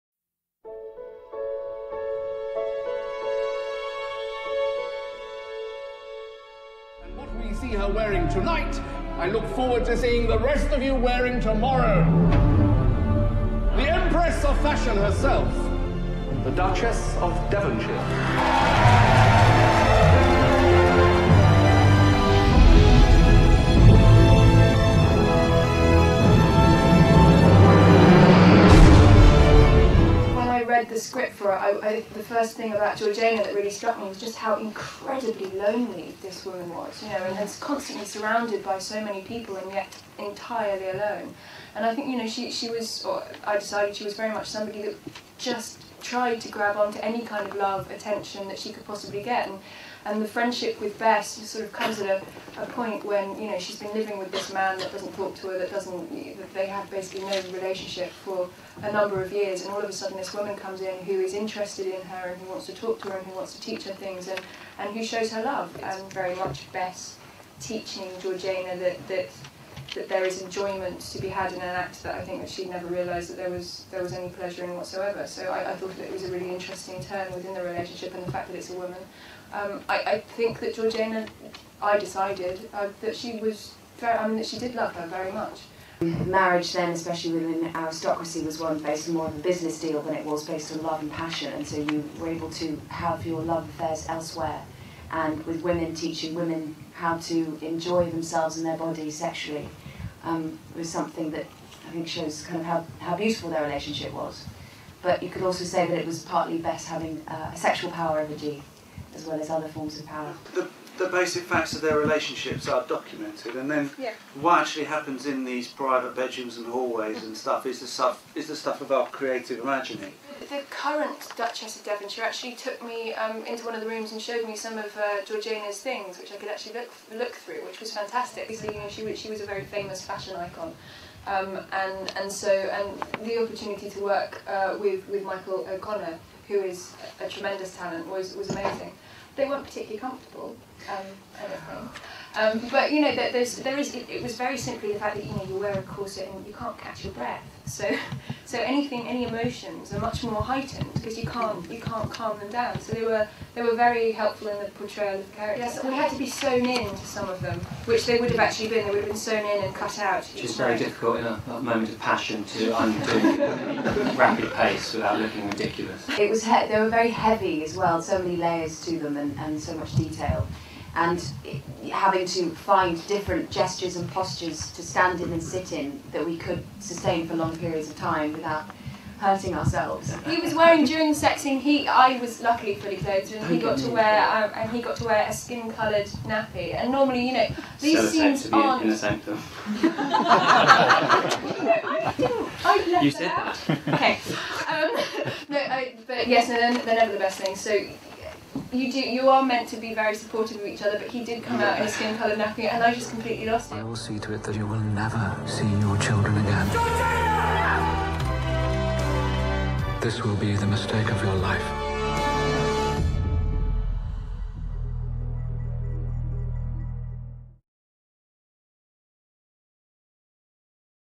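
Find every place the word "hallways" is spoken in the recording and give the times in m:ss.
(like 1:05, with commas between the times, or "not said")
1:56.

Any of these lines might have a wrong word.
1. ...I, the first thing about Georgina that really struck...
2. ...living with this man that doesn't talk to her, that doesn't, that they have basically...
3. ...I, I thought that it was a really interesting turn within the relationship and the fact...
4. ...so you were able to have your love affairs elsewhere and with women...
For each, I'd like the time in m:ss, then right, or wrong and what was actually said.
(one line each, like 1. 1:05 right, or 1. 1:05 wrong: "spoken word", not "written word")
1. 0:31 right
2. 0:53 right
3. 1:15 right
4. 1:31 right.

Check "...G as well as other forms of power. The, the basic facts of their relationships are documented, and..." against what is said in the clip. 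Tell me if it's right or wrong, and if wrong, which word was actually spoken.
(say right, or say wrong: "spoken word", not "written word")
right.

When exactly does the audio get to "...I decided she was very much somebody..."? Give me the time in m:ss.
0:43.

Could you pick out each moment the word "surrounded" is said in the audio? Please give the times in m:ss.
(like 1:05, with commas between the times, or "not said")
0:38.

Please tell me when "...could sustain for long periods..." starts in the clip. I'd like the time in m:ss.
2:56.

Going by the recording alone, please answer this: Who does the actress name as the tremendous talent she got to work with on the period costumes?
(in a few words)
Michael O'Connor.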